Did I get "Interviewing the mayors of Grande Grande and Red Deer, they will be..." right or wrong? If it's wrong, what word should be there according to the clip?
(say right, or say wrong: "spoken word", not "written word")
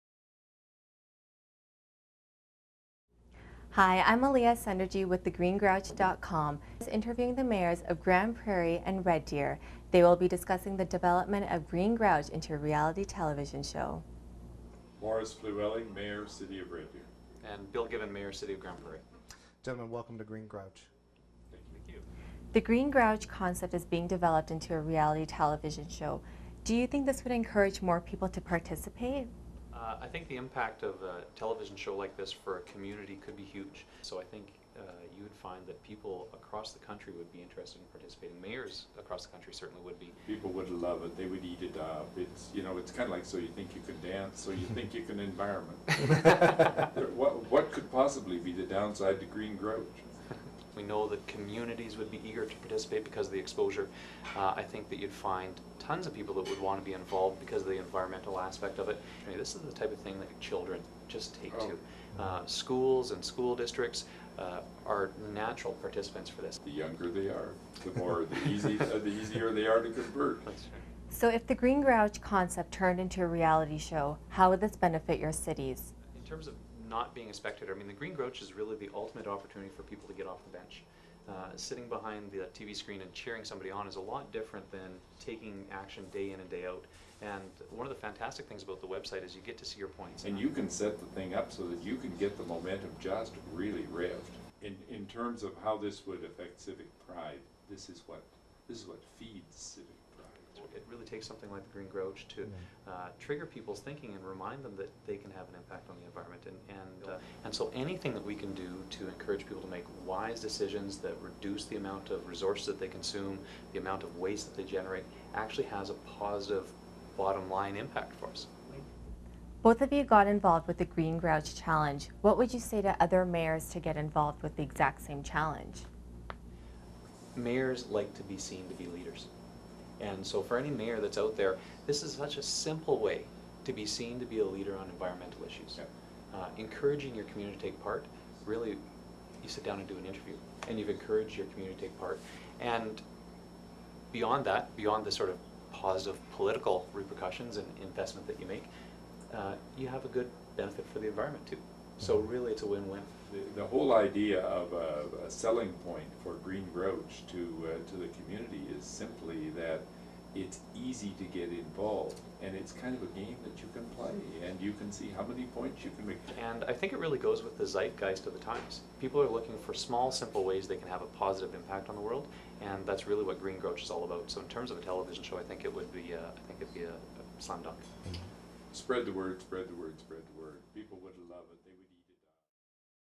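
wrong: "Prairie", not "Grande".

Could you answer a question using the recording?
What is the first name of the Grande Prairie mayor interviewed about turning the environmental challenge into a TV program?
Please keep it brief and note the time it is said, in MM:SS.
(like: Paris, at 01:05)
Bill, at 00:17.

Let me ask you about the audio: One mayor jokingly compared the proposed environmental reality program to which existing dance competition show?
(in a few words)
So You Think You Can Dance.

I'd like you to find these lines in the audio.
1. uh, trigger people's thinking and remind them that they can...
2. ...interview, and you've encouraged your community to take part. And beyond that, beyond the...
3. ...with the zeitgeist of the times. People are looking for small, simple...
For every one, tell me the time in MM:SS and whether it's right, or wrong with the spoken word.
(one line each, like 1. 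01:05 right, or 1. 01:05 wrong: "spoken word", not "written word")
1. 01:42 right
2. 02:20 right
3. 02:47 right.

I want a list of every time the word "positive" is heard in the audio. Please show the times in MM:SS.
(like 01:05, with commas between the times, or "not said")
01:56, 02:25, 02:51.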